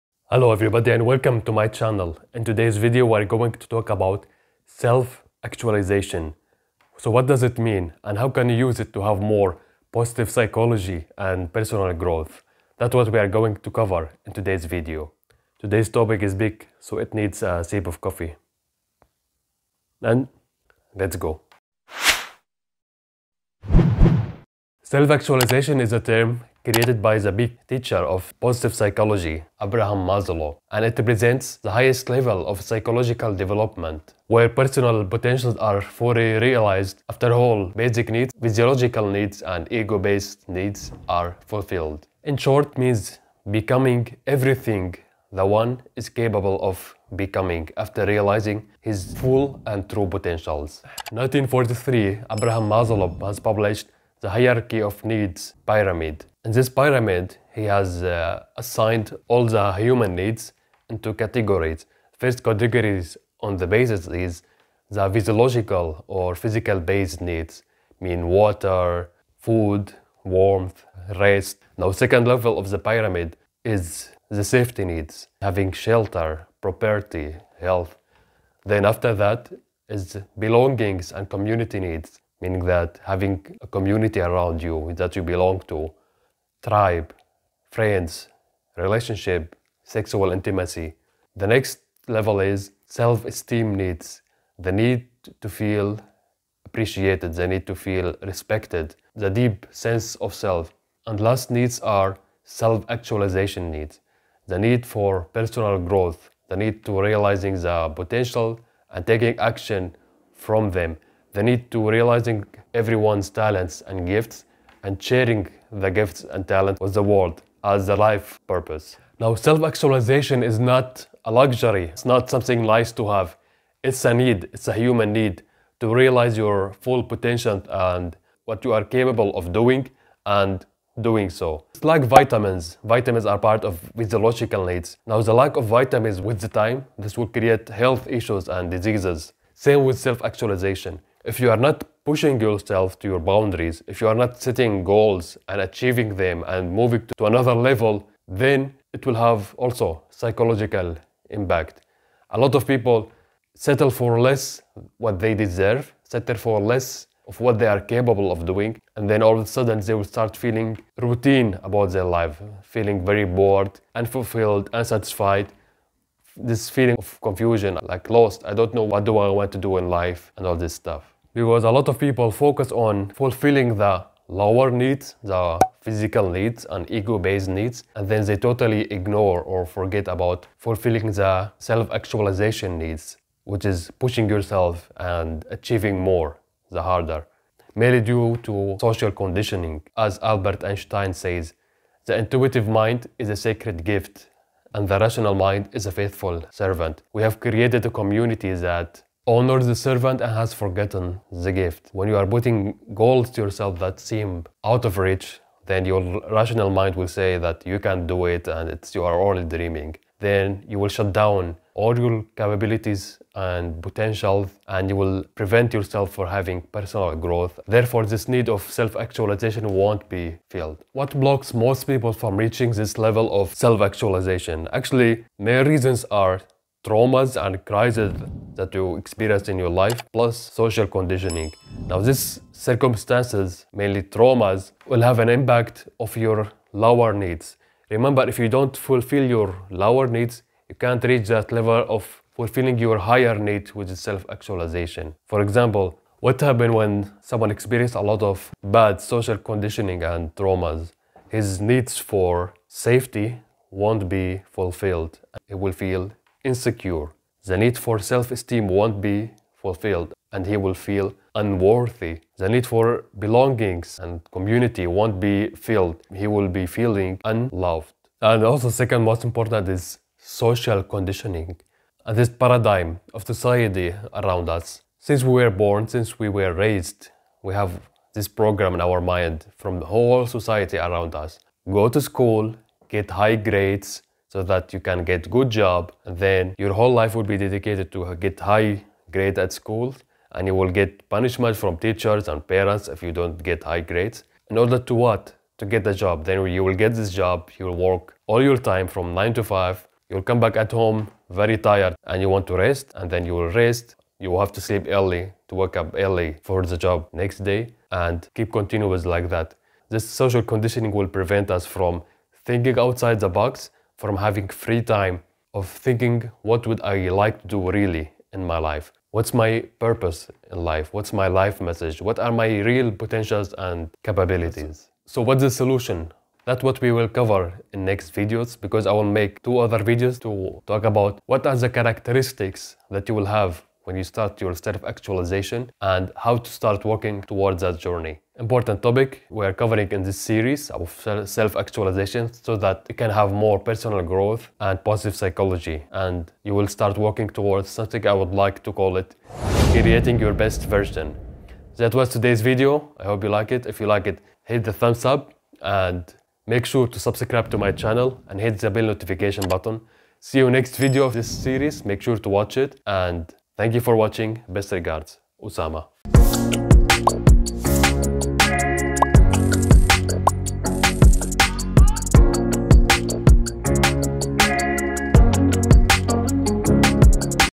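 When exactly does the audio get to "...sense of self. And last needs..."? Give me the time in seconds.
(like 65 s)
99 s.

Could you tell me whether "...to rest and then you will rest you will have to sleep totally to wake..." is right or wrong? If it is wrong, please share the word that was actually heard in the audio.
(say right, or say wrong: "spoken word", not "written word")
wrong: "early", not "totally".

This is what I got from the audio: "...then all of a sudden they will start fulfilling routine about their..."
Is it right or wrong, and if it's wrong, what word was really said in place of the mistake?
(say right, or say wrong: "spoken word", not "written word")
wrong: "feeling", not "fulfilling".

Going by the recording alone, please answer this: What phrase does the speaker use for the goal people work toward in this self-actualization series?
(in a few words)
Creating your best version.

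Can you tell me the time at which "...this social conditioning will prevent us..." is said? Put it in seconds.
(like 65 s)
309 s.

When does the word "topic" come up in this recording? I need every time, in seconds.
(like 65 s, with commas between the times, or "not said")
15 s, 338 s.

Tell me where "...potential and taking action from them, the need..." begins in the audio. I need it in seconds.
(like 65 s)
107 s.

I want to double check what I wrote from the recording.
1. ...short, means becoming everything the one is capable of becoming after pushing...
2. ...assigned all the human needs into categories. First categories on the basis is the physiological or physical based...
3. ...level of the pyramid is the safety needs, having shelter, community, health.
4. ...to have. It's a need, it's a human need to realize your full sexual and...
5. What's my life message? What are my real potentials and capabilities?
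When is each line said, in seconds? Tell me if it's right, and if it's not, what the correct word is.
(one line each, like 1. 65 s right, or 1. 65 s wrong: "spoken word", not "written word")
1. 42 s wrong: "realizing", not "pushing"
2. 58 s right
3. 72 s wrong: "property", not "community"
4. 122 s wrong: "potential", not "sexual"
5. 320 s right.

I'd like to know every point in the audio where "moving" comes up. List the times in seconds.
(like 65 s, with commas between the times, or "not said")
146 s.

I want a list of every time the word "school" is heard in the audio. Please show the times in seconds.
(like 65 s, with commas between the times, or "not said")
282 s, 289 s.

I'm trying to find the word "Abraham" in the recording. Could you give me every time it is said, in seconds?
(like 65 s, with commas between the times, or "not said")
29 s, 52 s.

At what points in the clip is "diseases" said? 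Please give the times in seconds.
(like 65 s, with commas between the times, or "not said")
138 s.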